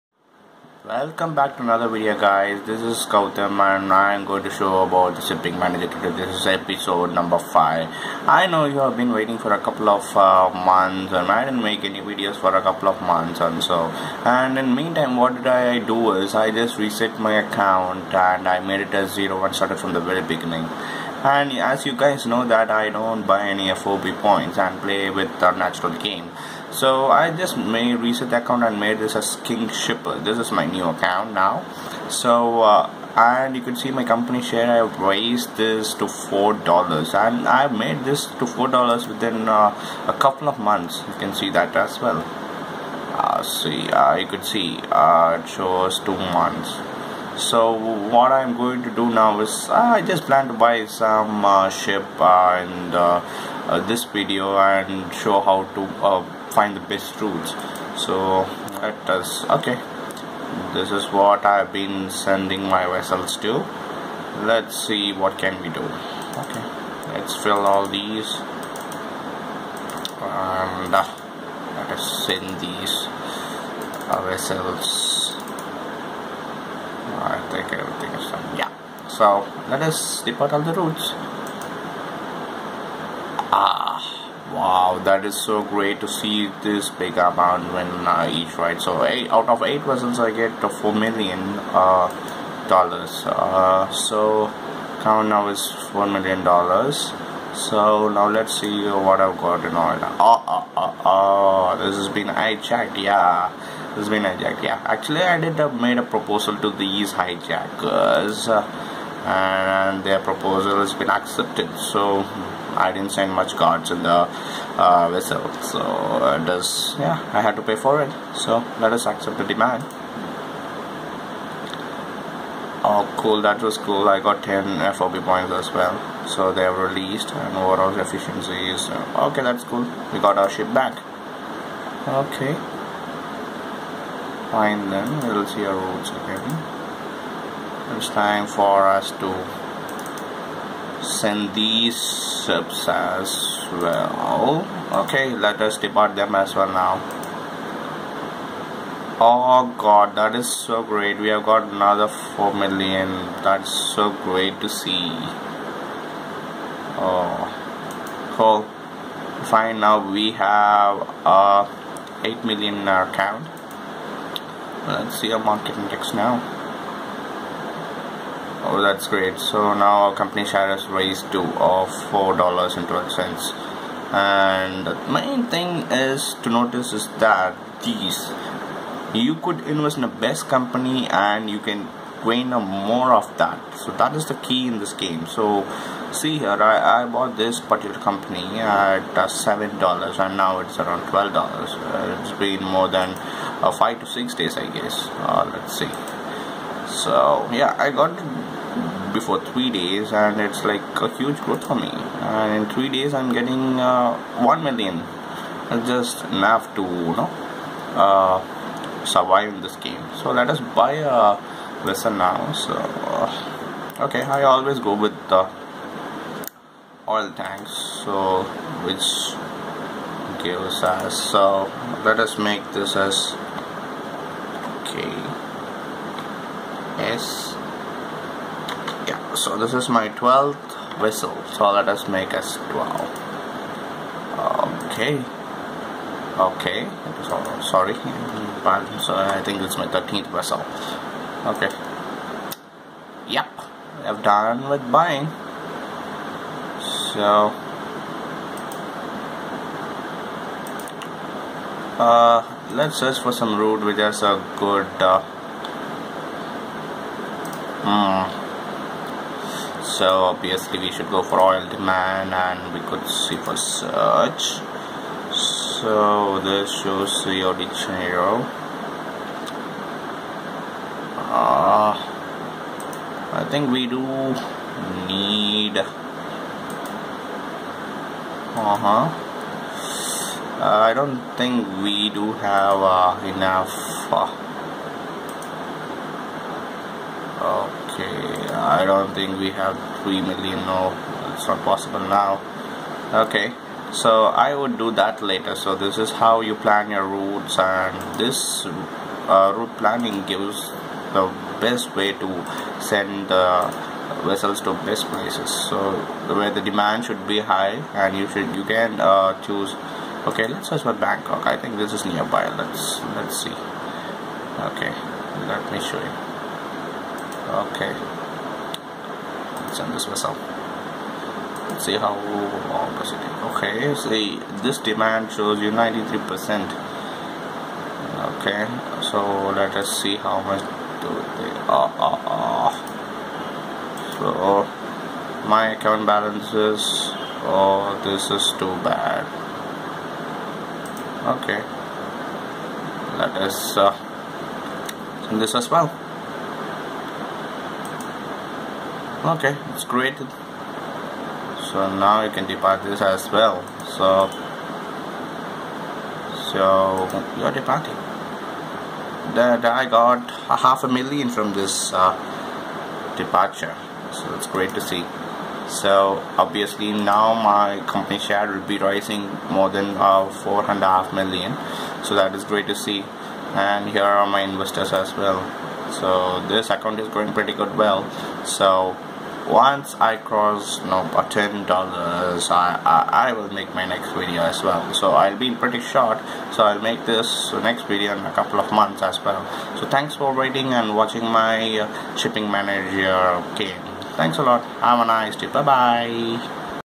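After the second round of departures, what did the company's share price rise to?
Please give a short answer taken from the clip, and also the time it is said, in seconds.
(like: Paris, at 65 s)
$4.12, at 172 s.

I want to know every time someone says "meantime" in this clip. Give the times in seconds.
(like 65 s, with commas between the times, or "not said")
14 s.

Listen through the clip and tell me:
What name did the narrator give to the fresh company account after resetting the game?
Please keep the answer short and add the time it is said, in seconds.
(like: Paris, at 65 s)
King Shipper, at 29 s.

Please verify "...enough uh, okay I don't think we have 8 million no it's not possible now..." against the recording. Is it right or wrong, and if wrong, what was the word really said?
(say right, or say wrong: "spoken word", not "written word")
wrong: "3", not "8".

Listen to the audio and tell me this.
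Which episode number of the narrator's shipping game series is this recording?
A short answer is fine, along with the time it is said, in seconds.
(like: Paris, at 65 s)
5, at 6 s.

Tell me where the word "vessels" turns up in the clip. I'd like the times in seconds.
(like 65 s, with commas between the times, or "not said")
62 s, 74 s, 89 s, 115 s, 211 s, 304 s.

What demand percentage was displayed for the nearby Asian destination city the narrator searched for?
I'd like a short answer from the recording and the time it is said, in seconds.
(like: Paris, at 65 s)
93%, at 325 s.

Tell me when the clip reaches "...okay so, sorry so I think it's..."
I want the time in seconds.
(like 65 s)
236 s.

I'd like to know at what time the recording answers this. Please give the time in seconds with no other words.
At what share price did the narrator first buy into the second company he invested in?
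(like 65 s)
189 s.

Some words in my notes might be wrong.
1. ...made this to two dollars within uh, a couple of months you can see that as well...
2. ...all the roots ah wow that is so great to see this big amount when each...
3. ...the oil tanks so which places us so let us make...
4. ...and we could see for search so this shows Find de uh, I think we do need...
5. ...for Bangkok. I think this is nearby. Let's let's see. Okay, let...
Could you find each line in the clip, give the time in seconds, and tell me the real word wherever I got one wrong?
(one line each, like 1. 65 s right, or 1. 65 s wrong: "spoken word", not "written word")
1. 37 s wrong: "four", not "two"
2. 80 s right
3. 215 s wrong: "gives", not "places"
4. 262 s wrong: "Rio", not "Find"
5. 310 s right.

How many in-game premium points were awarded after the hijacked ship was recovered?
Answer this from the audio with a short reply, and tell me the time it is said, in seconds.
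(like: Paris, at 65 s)
10, at 124 s.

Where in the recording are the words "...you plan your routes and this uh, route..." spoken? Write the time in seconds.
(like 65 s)
296 s.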